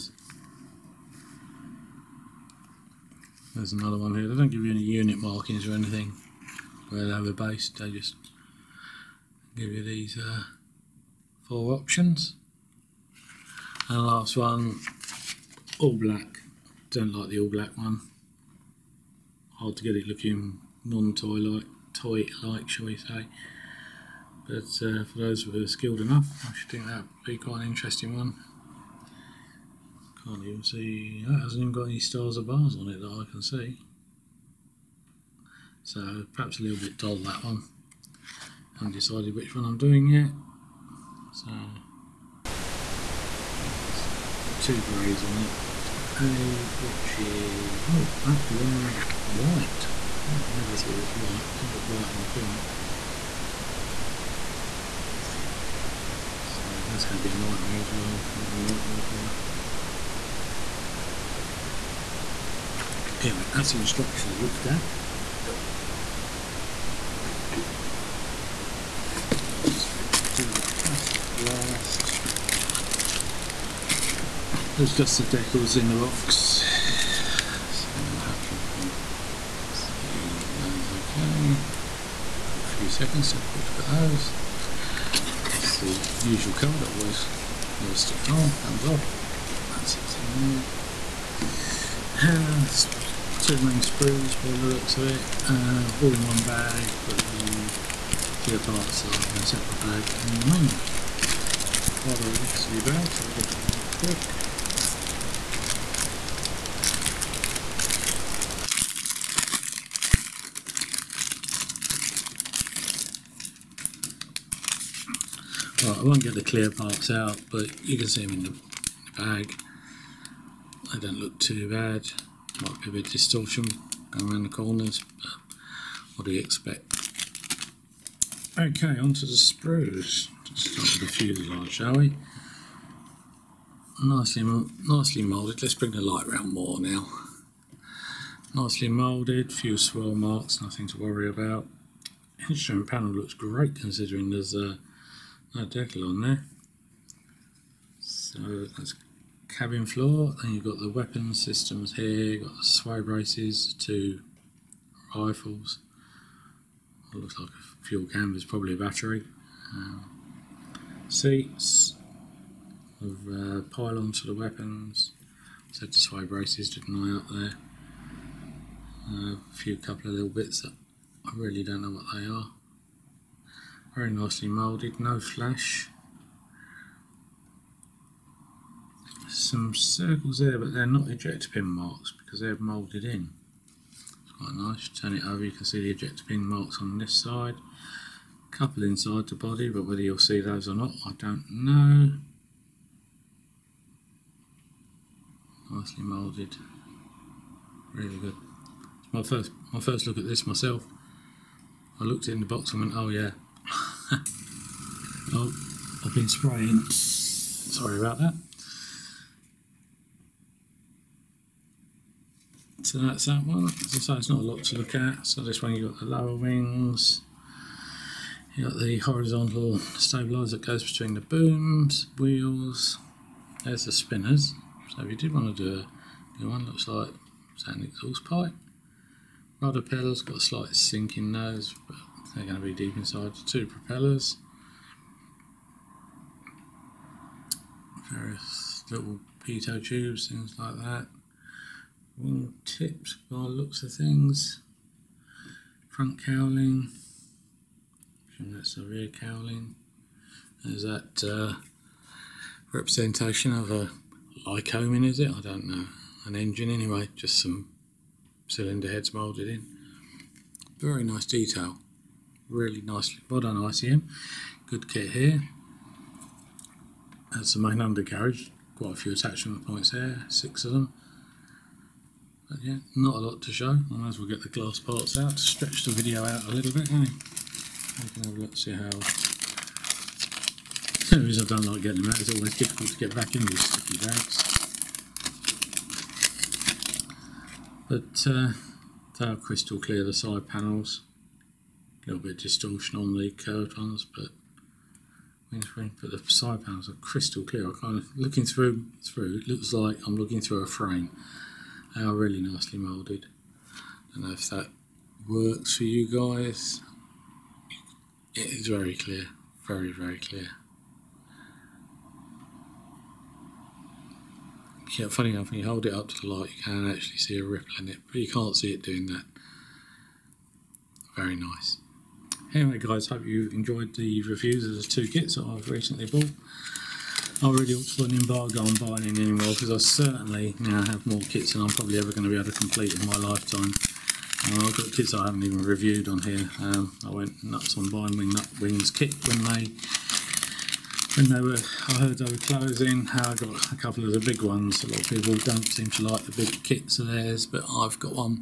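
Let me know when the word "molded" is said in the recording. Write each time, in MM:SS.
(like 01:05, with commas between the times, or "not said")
02:54, 03:02, 03:16.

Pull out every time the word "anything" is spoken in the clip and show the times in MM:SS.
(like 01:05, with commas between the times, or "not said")
00:05.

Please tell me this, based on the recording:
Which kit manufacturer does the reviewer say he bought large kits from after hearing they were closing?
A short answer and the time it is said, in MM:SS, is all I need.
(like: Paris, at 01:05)
Wingnut Wings, at 05:38.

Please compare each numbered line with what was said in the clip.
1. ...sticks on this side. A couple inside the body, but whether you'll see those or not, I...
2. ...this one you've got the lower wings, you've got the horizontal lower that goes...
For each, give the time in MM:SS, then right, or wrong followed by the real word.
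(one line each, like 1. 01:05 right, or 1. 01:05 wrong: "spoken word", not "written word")
1. 03:06 wrong: "marks", not "sticks"
2. 03:35 wrong: "stabiliser", not "lower".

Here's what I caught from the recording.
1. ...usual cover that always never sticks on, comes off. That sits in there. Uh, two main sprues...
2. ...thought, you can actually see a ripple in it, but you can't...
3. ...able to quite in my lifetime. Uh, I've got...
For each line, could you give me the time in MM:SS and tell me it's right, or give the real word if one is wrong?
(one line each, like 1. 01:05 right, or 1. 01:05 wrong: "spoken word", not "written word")
1. 01:26 right
2. 05:16 wrong: "light", not "thought"
3. 05:32 wrong: "complete", not "quite".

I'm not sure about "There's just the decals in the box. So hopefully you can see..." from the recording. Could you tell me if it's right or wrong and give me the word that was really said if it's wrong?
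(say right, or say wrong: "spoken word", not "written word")
right.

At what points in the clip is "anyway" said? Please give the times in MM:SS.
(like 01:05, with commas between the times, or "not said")
01:03, 04:16, 05:22.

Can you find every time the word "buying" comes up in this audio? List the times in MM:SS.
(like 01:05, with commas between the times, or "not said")
05:28, 05:37.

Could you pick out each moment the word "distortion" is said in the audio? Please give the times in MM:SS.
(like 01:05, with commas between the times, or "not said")
02:03, 04:52.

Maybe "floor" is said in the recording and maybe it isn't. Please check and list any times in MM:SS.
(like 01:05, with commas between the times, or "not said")
02:29.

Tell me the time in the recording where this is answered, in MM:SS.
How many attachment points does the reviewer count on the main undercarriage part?
04:30.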